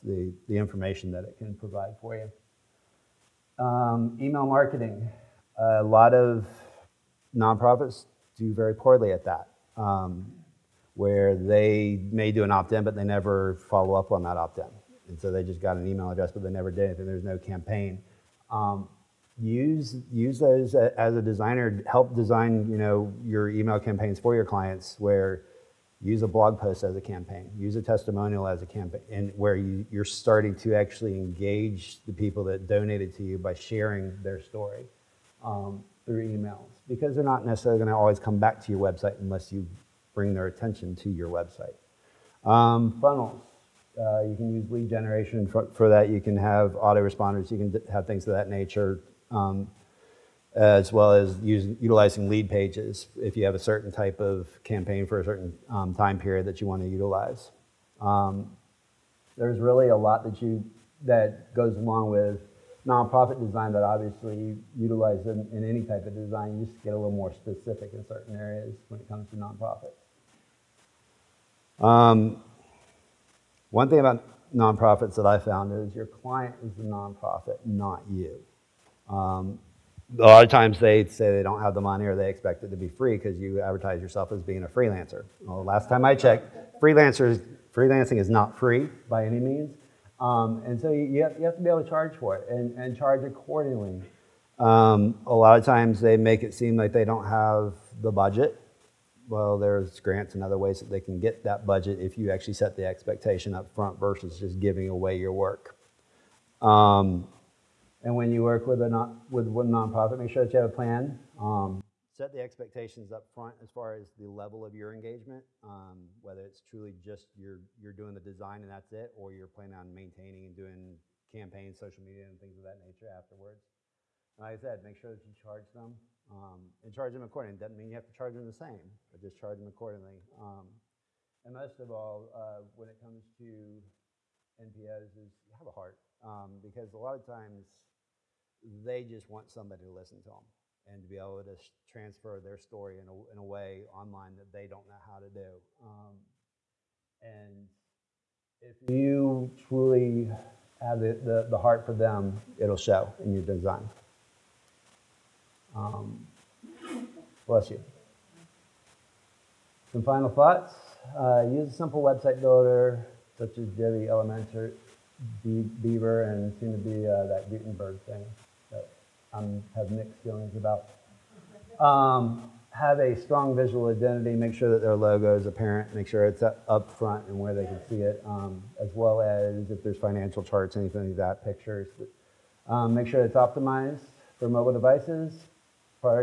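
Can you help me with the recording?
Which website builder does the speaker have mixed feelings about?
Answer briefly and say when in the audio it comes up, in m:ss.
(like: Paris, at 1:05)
Gutenberg, at 2:47.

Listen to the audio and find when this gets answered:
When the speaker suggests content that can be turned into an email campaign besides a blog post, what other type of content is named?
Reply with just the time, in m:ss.
0:27.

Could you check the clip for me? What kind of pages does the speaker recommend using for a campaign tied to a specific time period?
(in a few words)
Lead pages.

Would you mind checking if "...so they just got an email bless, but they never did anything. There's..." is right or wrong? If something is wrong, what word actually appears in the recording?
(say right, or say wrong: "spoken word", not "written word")
wrong: "address", not "bless".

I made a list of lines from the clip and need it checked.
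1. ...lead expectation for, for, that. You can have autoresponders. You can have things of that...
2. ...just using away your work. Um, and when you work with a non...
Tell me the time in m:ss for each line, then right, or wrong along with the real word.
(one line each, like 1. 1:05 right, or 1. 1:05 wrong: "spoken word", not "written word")
1. 0:44 wrong: "generation", not "expectation"
2. 1:44 wrong: "giving", not "using".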